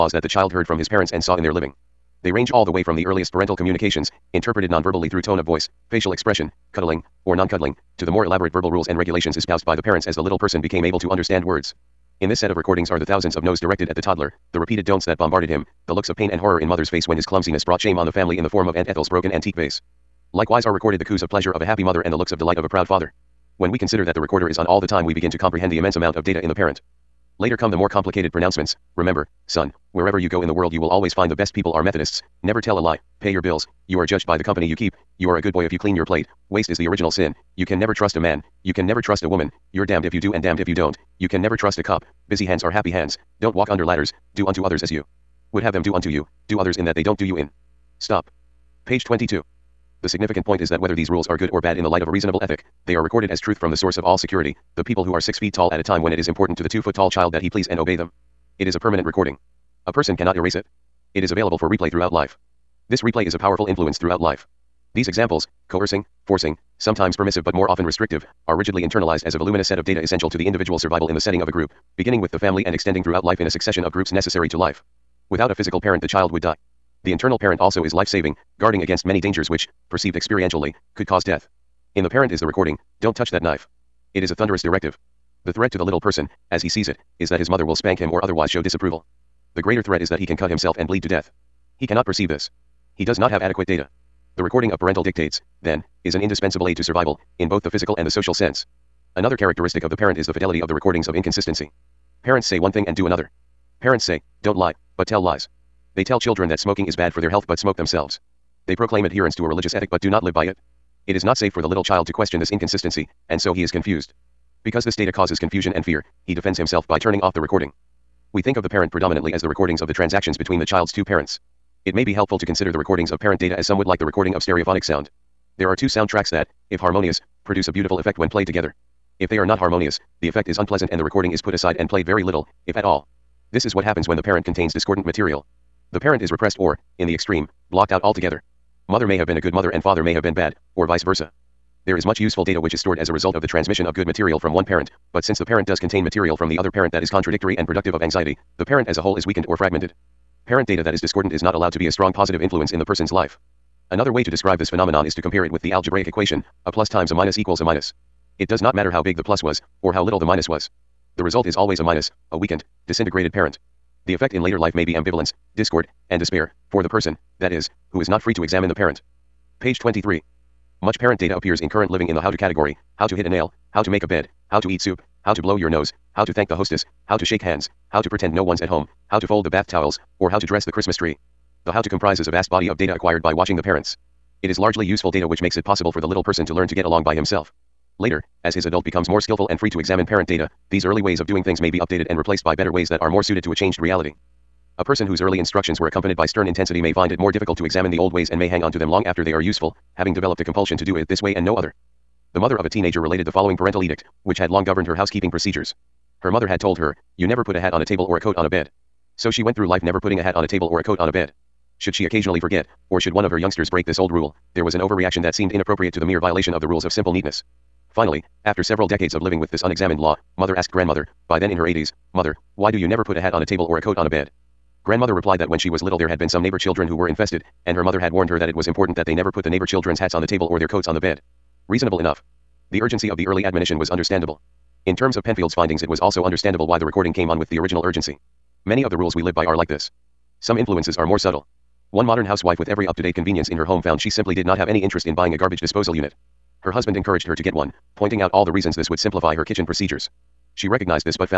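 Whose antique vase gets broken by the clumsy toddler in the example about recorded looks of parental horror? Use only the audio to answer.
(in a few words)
Aunt Ethel.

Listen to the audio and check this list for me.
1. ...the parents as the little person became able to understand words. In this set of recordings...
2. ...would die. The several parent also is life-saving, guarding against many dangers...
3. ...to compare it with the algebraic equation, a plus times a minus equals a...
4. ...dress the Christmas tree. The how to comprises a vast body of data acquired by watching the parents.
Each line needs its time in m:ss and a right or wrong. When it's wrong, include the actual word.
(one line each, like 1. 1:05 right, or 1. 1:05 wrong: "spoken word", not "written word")
1. 0:09 right
2. 1:16 wrong: "internal", not "several"
3. 2:35 right
4. 3:00 right.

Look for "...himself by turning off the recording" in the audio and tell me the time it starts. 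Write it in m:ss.
1:56.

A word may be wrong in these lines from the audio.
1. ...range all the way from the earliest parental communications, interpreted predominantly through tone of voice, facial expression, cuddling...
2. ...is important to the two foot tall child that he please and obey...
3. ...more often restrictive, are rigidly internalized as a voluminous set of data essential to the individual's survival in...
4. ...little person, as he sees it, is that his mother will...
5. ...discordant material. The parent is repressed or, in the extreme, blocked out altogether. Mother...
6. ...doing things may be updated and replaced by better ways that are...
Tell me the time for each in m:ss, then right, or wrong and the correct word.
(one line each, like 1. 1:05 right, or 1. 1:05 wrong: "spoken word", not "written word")
1. 0:02 wrong: "nonverbally", not "predominantly"
2. 0:56 right
3. 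1:07 right
4. 1:25 right
5. 2:14 right
6. 3:11 right.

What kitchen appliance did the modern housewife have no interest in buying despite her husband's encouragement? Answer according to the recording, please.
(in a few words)
garbage disposal unit.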